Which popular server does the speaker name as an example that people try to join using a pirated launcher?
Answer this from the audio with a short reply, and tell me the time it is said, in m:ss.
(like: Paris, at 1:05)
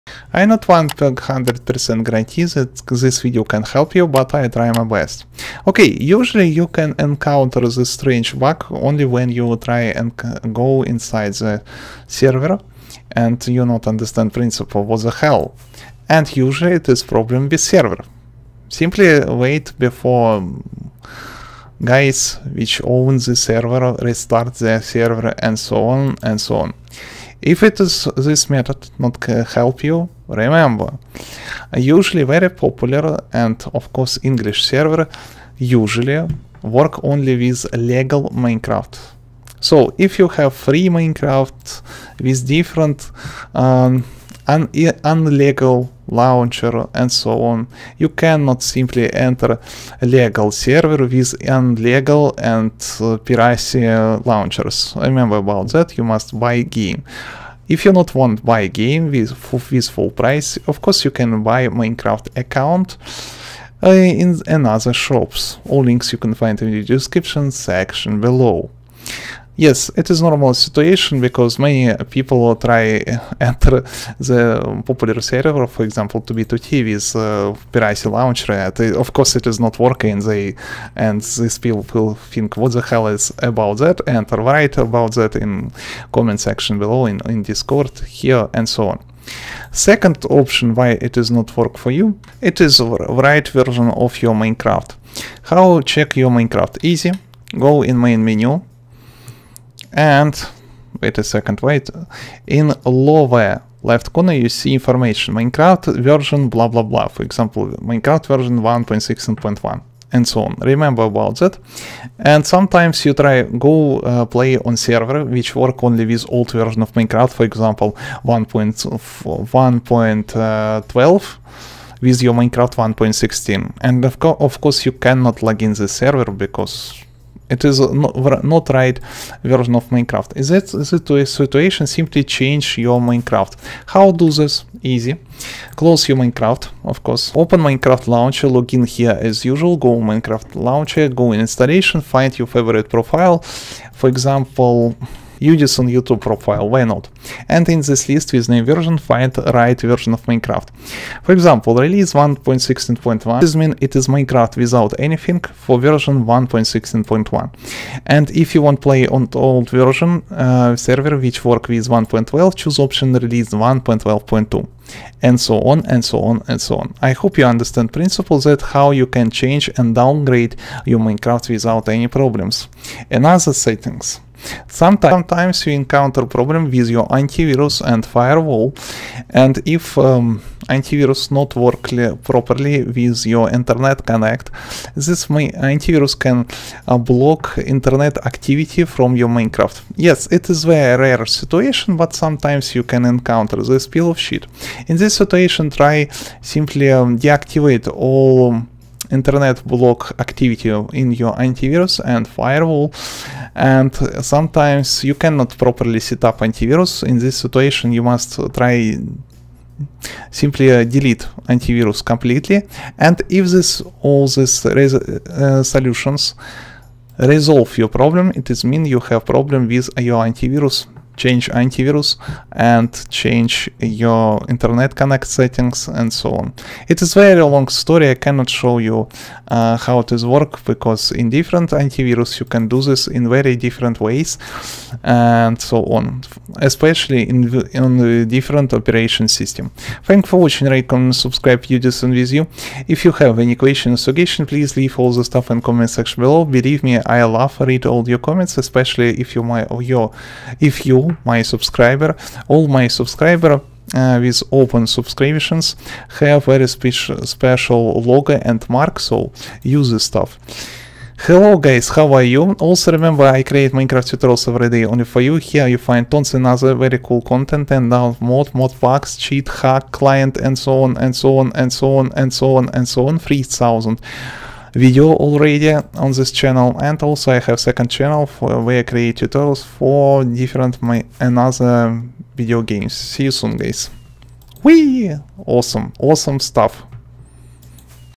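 2b2t, at 1:16.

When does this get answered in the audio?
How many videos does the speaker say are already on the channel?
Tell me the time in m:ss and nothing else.
4:33.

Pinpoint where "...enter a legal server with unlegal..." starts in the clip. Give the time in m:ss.
0:49.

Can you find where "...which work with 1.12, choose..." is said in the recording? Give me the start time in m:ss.
2:41.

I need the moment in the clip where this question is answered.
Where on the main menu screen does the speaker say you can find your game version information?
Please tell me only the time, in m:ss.
1:42.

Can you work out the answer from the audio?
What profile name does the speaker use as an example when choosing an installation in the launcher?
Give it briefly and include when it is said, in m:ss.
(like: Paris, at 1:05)
Udisen YouTube profile, at 2:25.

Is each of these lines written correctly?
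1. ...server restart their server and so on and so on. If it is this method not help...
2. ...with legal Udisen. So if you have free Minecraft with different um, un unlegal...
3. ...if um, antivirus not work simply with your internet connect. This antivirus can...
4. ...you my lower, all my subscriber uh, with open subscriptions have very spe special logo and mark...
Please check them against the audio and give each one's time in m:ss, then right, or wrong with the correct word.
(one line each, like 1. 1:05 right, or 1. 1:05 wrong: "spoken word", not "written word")
1. 0:23 right
2. 0:37 wrong: "Minecraft", not "Udisen"
3. 2:59 wrong: "properly", not "simply"
4. 4:10 wrong: "subscriber", not "lower".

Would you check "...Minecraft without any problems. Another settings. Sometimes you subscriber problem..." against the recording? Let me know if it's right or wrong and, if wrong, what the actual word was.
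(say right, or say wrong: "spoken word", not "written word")
wrong: "encounter", not "subscriber".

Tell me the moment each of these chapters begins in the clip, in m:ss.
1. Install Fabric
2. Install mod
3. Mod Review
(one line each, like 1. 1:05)
1. 1:03
2. 2:19
3. 3:16.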